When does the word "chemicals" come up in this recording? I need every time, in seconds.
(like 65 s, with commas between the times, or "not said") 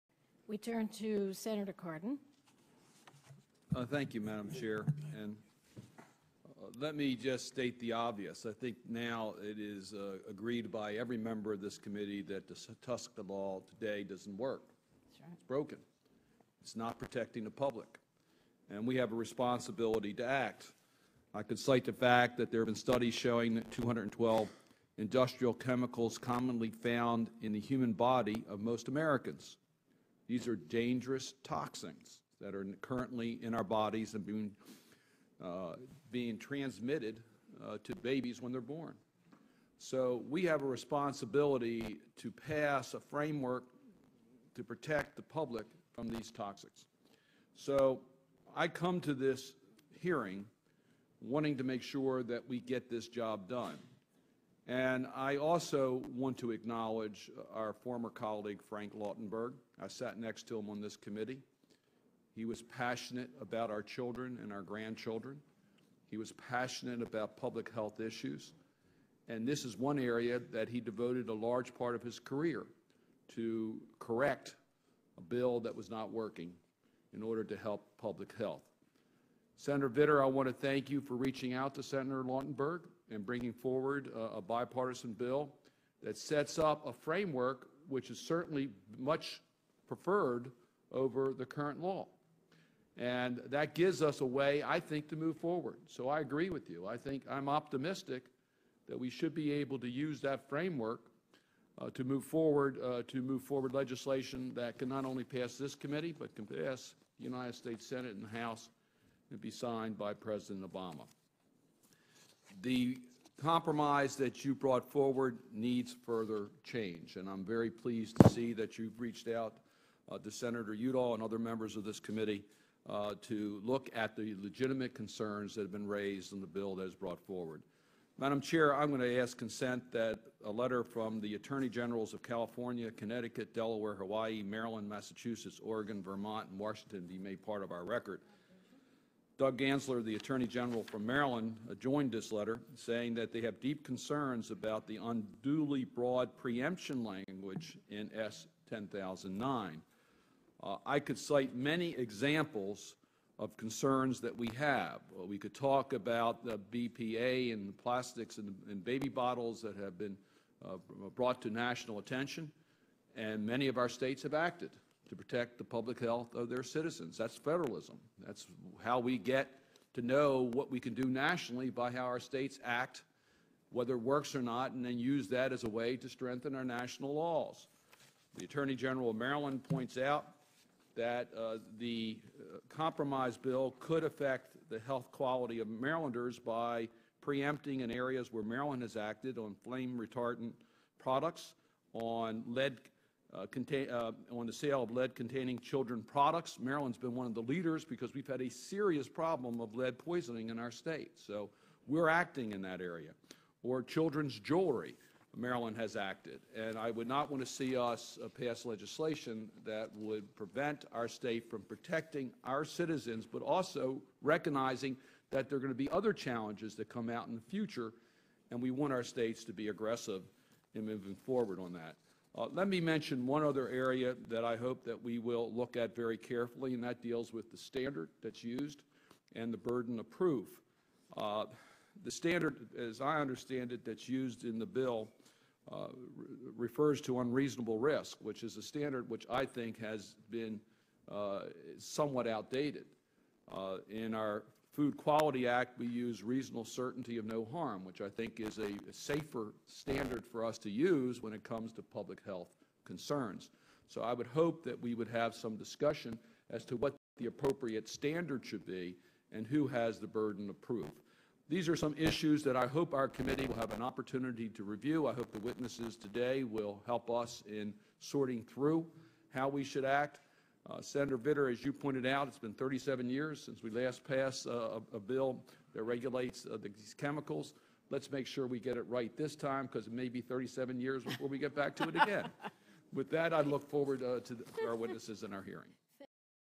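25 s, 276 s.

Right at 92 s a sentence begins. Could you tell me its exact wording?
And that gives us a way, I think, to move forward.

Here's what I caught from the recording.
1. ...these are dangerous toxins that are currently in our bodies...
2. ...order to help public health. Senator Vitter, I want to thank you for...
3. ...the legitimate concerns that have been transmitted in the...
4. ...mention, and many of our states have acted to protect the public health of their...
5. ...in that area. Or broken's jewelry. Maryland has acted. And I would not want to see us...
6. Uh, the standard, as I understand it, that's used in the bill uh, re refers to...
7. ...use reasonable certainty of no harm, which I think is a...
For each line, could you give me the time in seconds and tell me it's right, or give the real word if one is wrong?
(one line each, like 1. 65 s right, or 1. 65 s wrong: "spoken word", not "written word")
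1. 30 s right
2. 77 s right
3. 124 s wrong: "raised", not "transmitted"
4. 161 s wrong: "attention", not "mention"
5. 202 s wrong: "children", not "broken"
6. 231 s right
7. 245 s right.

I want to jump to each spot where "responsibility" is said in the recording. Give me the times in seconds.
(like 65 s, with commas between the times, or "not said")
19 s, 40 s.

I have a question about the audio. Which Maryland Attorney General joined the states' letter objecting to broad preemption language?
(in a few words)
Doug Gansler.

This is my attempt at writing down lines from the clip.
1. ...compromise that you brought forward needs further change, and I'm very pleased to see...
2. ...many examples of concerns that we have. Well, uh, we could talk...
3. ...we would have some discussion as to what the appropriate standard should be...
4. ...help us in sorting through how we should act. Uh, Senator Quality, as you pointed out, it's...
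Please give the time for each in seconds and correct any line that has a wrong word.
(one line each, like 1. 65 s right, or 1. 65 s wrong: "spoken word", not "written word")
1. 113 s right
2. 151 s right
3. 254 s right
4. 266 s wrong: "Vitter", not "Quality".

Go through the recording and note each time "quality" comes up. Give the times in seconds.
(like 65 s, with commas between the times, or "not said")
185 s, 244 s.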